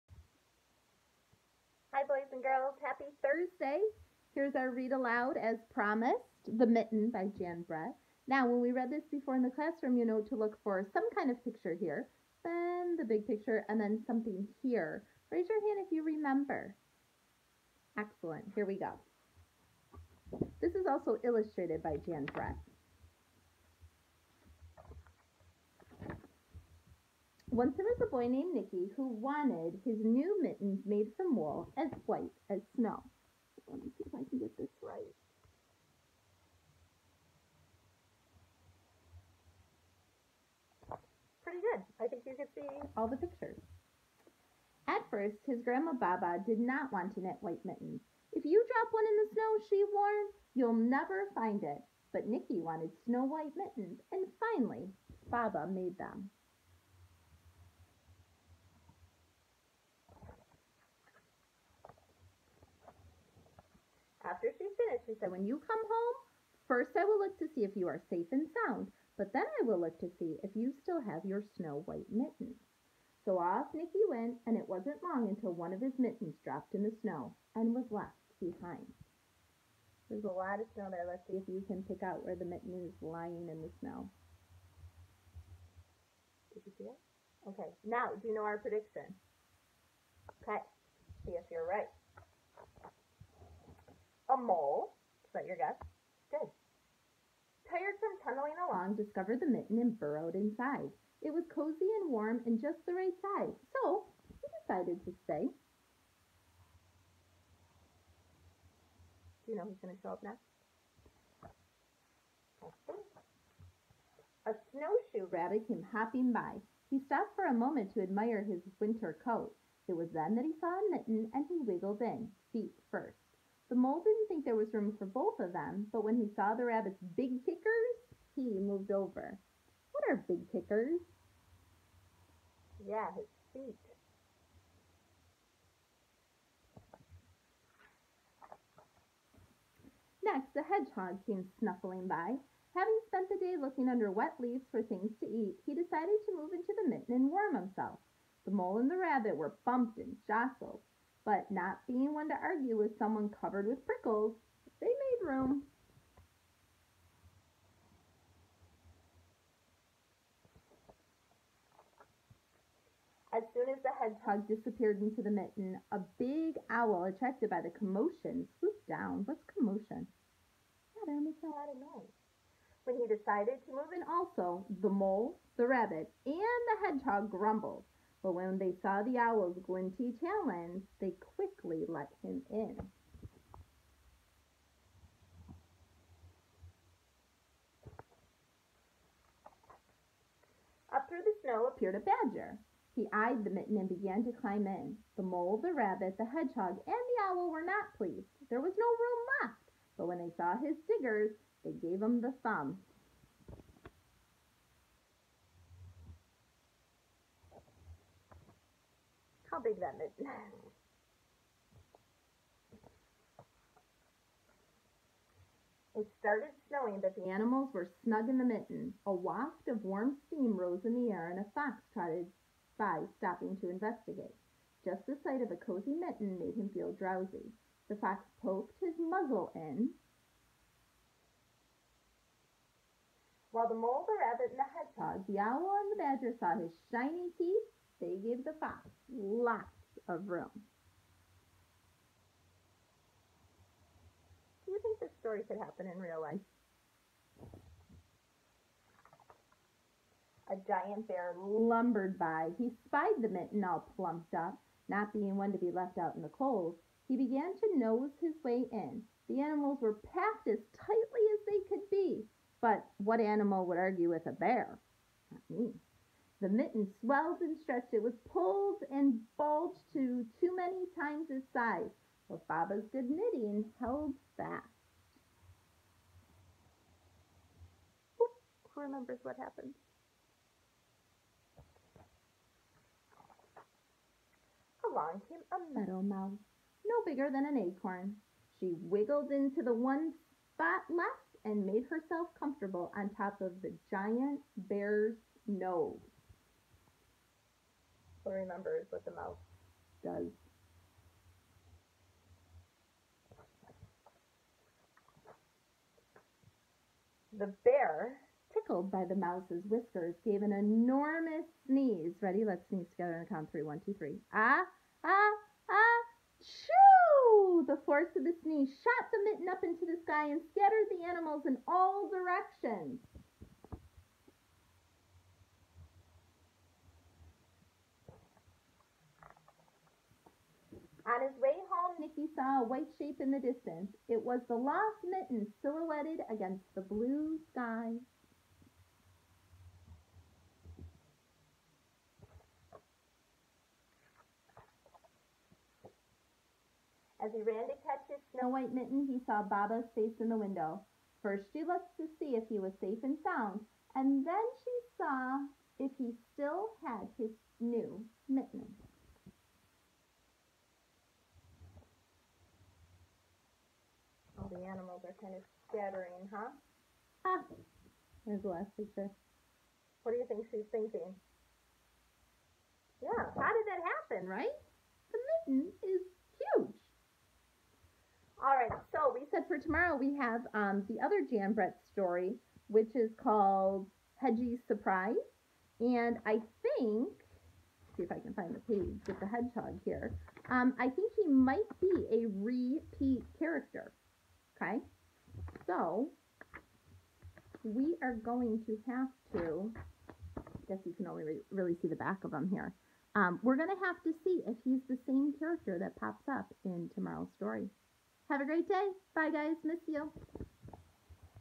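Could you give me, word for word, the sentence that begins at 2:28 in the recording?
The mole and the rabbit were bumped and jostled.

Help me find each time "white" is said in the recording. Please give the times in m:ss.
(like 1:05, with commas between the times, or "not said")
0:32, 0:47, 0:53, 1:11, 5:32, 5:48.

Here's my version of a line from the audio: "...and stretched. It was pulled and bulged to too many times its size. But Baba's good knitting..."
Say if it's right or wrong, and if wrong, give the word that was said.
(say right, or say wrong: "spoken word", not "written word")
right.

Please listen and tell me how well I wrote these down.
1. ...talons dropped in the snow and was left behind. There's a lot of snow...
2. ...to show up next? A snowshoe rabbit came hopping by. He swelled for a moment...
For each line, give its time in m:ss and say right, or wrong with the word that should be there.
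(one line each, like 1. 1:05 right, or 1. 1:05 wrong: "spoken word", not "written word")
1. 1:15 wrong: "mittens", not "talons"
2. 1:49 wrong: "stopped", not "swelled".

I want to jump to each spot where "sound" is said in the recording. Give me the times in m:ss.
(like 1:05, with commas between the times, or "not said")
1:08, 5:53.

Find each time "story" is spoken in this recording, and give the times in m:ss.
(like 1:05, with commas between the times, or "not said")
4:05, 6:21, 6:47.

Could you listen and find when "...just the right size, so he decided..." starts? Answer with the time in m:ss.
1:42.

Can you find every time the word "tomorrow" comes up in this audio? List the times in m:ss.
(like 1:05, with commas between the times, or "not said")
6:19, 6:46.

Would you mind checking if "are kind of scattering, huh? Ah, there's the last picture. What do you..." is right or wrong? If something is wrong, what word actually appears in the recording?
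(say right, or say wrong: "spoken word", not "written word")
right.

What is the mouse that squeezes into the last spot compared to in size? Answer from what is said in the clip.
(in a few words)
An acorn.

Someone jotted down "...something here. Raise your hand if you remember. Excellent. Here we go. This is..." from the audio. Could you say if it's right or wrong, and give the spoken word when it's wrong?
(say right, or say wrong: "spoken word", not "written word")
right.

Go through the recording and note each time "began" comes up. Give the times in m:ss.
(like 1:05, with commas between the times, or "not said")
3:13, 4:17.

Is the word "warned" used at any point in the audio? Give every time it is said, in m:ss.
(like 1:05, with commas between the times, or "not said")
0:49.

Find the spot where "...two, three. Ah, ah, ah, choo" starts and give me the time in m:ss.
5:13.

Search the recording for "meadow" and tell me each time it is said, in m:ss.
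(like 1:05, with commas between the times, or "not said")
4:45.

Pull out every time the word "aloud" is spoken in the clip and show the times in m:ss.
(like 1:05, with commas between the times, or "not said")
0:04.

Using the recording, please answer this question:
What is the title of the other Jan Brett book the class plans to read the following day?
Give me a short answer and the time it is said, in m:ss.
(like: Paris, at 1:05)
Hedgie's Surprise, at 6:24.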